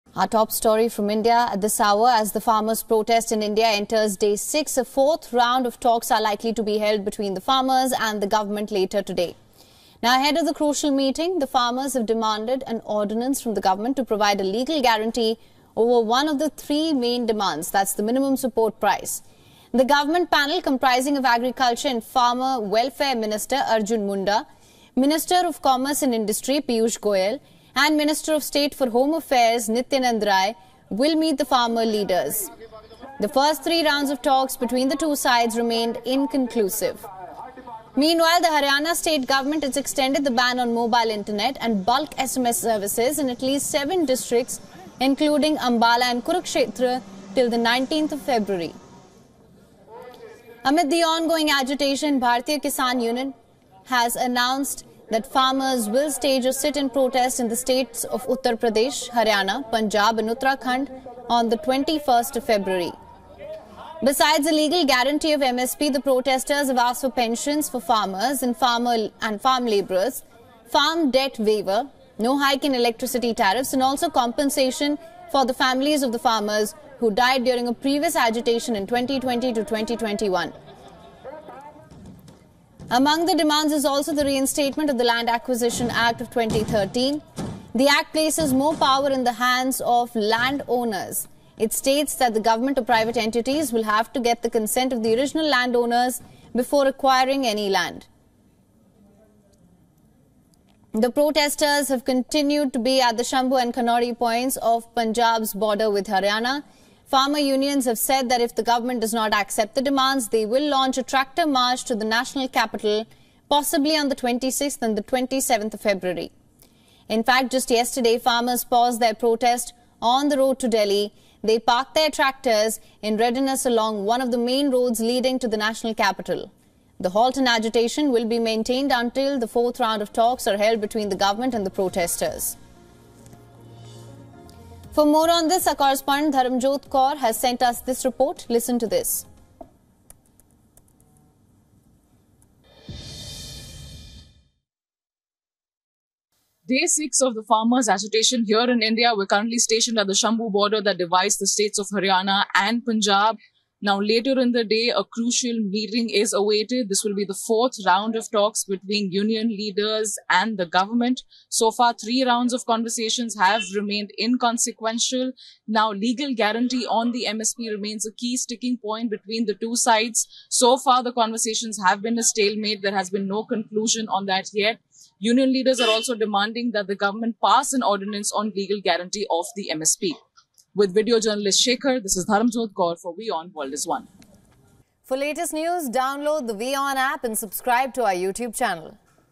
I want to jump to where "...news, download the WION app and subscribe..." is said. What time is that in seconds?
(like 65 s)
185 s.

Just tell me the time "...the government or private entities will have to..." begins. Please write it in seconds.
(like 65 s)
92 s.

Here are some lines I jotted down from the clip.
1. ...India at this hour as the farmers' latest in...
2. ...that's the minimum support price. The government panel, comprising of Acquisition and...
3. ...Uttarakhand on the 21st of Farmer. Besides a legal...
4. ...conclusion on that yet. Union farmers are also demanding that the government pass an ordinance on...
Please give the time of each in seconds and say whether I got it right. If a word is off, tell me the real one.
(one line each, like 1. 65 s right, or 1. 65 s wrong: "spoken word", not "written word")
1. 1 s wrong: "protest", not "latest"
2. 17 s wrong: "Agriculture", not "Acquisition"
3. 60 s wrong: "February", not "Farmer"
4. 173 s wrong: "leaders", not "farmers".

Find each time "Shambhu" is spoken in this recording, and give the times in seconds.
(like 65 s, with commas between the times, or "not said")
103 s, 150 s.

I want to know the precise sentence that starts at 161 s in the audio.
So far, three rounds of conversations have remained inconsequential.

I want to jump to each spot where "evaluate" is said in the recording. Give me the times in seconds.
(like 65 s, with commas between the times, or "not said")
not said.